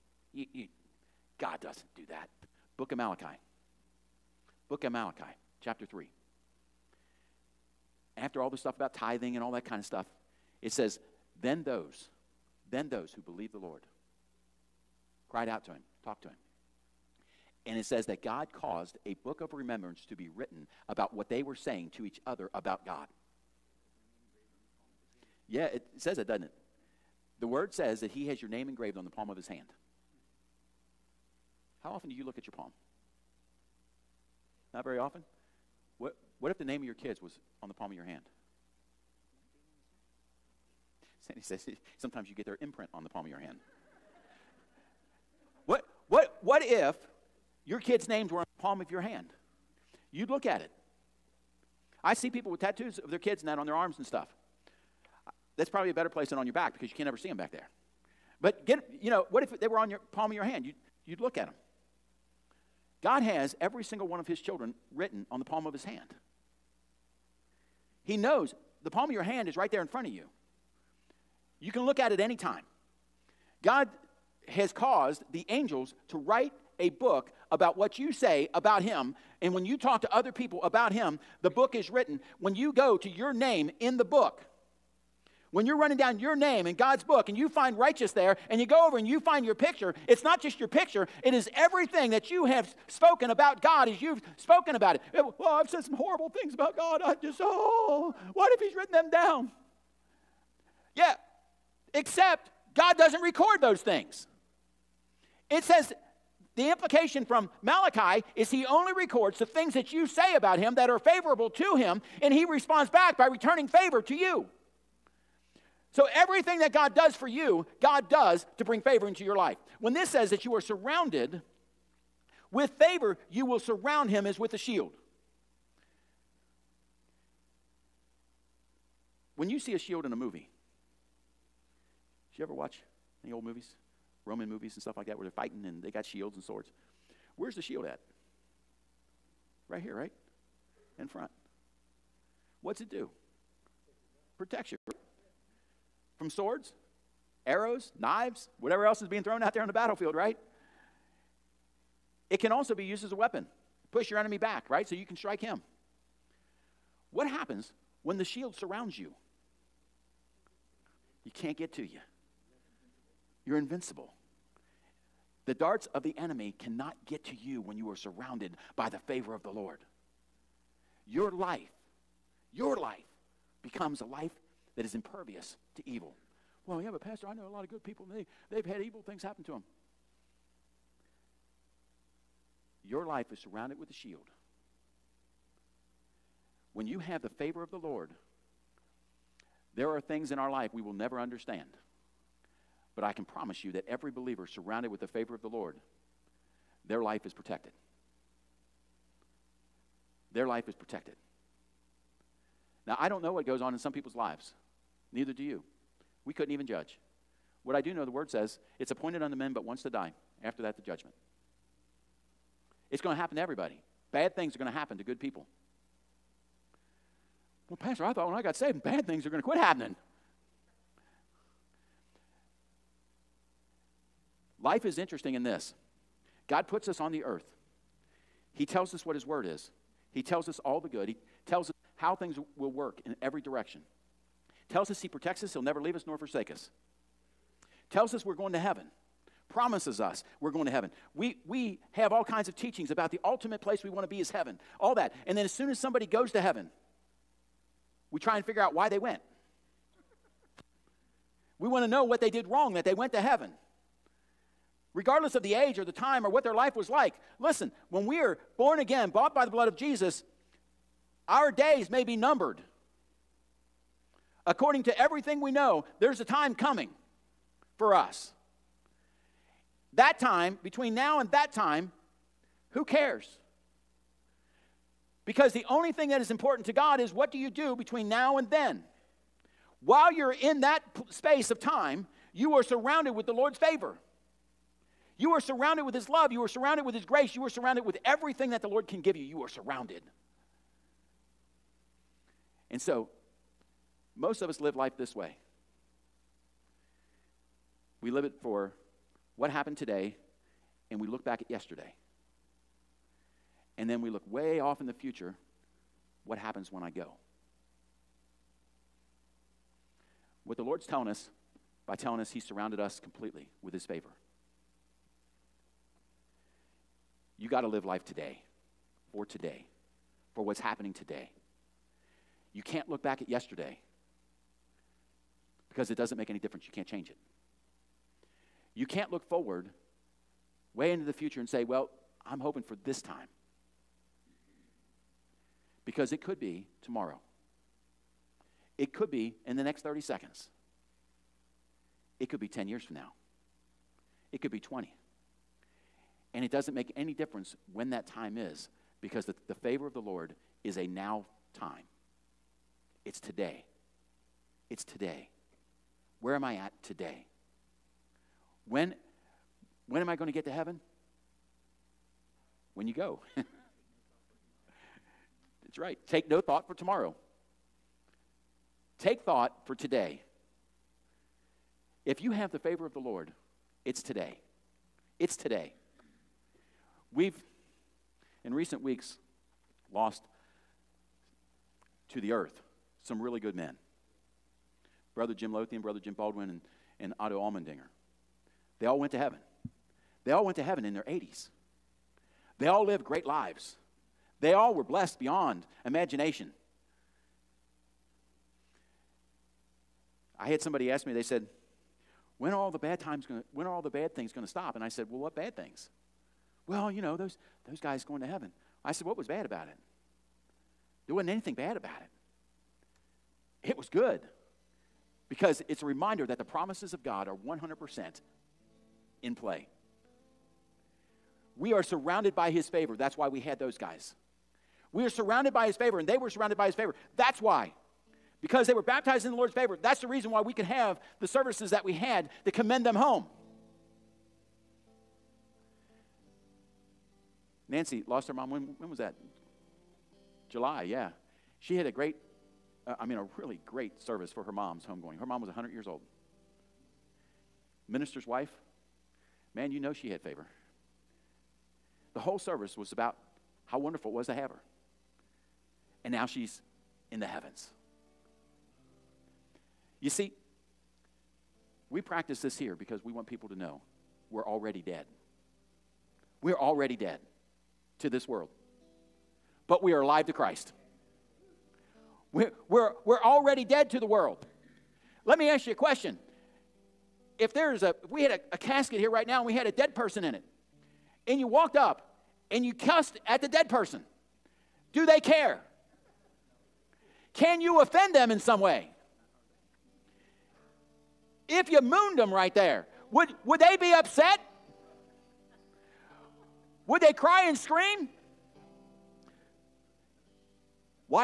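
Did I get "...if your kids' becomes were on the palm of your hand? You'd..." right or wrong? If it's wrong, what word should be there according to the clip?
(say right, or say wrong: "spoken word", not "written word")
wrong: "names", not "becomes".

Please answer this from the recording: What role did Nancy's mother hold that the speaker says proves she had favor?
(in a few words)
Minister's wife.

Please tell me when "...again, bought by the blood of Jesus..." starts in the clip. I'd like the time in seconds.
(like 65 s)
258 s.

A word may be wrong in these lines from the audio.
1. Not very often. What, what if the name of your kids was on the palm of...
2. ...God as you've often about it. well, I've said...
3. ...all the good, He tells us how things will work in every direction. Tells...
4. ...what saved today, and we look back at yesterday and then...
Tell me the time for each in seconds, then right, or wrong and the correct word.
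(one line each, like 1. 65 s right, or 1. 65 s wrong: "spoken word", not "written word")
1. 34 s right
2. 93 s wrong: "spoken", not "often"
3. 230 s right
4. 299 s wrong: "happened", not "saved".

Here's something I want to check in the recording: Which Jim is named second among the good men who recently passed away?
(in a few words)
Jim Baldwin.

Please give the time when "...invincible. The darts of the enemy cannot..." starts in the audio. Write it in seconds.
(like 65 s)
163 s.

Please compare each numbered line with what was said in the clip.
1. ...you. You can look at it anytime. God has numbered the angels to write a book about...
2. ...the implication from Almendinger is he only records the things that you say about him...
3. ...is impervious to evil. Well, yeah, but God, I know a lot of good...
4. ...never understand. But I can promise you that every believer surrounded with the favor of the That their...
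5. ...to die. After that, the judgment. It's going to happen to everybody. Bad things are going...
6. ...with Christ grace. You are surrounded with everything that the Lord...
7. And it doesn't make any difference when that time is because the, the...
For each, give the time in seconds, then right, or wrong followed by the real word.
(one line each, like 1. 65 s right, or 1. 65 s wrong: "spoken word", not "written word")
1. 70 s wrong: "caused", not "numbered"
2. 106 s wrong: "Malachi", not "Almendinger"
3. 174 s wrong: "Pastor", not "God"
4. 190 s wrong: "Lord", not "That"
5. 209 s right
6. 286 s wrong: "His", not "Christ"
7. 346 s right.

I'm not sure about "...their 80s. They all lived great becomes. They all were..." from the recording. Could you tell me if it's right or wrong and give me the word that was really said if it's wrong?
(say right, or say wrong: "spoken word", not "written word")
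wrong: "lives", not "becomes".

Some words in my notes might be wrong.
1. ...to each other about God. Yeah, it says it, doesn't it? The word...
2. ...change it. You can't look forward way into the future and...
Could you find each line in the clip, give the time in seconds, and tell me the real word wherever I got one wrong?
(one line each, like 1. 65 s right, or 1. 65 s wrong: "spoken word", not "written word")
1. 21 s right
2. 326 s right.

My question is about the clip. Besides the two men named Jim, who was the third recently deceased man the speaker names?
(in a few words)
Otto Almendinger.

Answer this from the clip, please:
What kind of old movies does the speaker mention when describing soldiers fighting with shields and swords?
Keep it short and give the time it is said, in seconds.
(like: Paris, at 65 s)
Roman movies, at 134 s.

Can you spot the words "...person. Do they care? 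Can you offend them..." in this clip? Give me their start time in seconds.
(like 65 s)
483 s.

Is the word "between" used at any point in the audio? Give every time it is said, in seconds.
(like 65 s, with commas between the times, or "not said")
270 s, 277 s.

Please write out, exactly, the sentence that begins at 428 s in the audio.
Because they were baptized in the Lord's favor.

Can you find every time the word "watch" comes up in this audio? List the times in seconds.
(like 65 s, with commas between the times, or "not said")
132 s.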